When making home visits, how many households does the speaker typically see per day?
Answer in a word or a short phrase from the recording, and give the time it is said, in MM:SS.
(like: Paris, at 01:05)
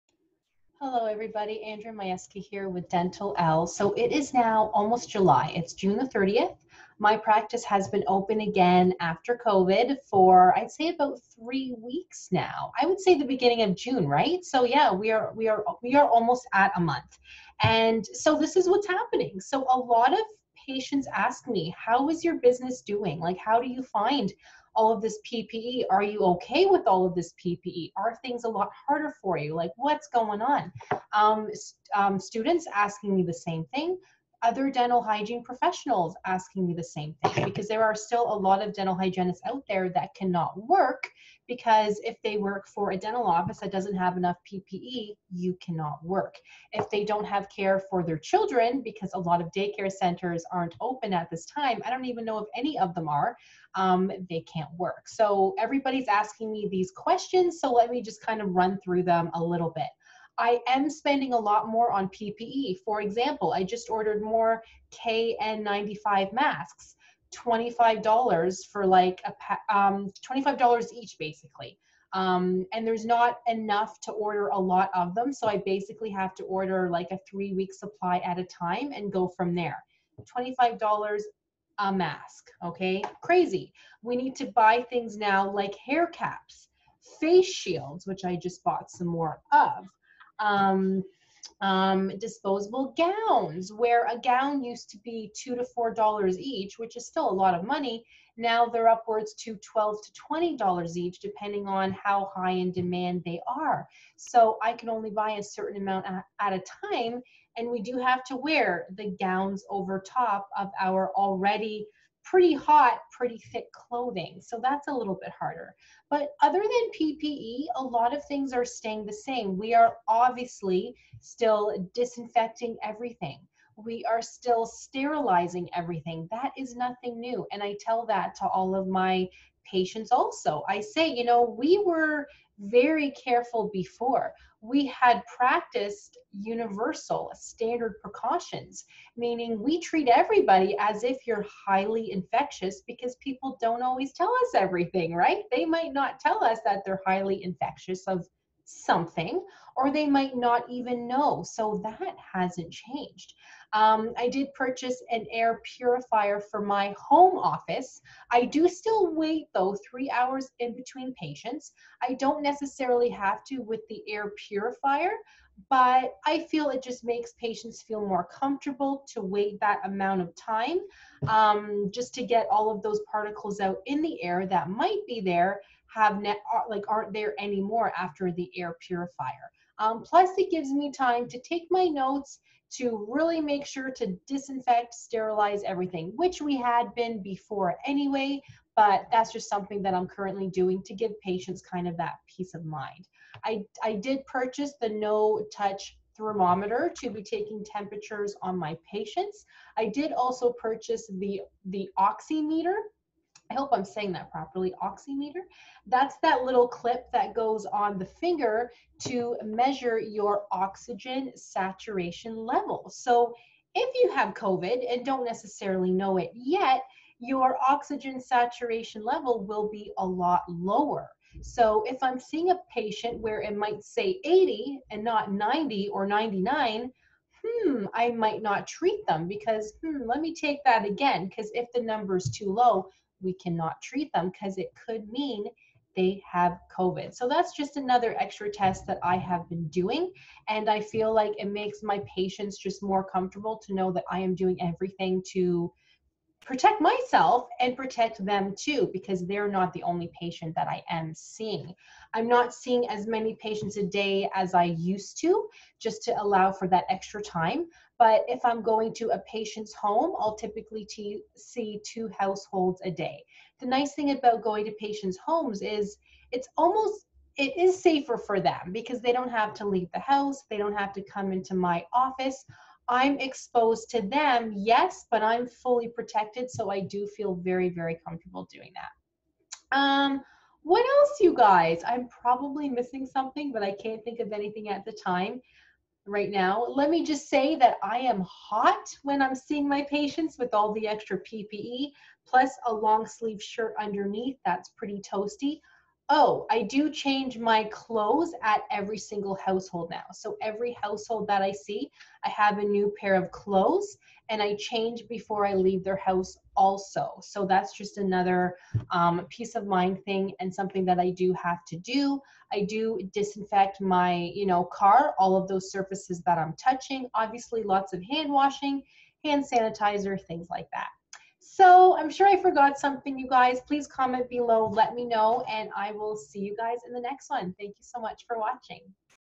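2, at 04:21.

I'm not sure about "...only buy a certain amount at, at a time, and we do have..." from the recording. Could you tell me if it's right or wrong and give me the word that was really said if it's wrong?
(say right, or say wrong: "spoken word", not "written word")
right.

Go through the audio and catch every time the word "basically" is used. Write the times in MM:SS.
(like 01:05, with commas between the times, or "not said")
01:11, 01:15.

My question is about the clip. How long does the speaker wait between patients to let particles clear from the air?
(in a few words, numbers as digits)
3 hours.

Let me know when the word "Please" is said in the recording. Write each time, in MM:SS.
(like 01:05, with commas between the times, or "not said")
05:23.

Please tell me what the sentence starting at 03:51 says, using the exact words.
Because if the number is too low, we cannot treat them because it could mean they have COVID.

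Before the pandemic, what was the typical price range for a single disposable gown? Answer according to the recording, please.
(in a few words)
2 to 4 dollars.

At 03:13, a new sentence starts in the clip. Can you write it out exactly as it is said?
I, I did purchase the no touch thermometer to be taking temperatures on my patients.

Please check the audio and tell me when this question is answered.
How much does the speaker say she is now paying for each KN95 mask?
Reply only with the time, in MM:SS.
01:10.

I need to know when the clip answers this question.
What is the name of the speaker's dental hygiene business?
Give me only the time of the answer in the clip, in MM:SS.
00:02.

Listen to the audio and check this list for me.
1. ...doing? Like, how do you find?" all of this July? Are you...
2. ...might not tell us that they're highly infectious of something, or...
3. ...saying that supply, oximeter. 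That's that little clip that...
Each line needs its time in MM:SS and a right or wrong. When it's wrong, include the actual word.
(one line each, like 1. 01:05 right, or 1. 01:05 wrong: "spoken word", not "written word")
1. 00:22 wrong: "PPE", not "July"
2. 02:25 right
3. 03:23 wrong: "properly", not "supply".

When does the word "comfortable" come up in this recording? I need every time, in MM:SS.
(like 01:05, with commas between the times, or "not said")
02:48, 04:03, 04:38.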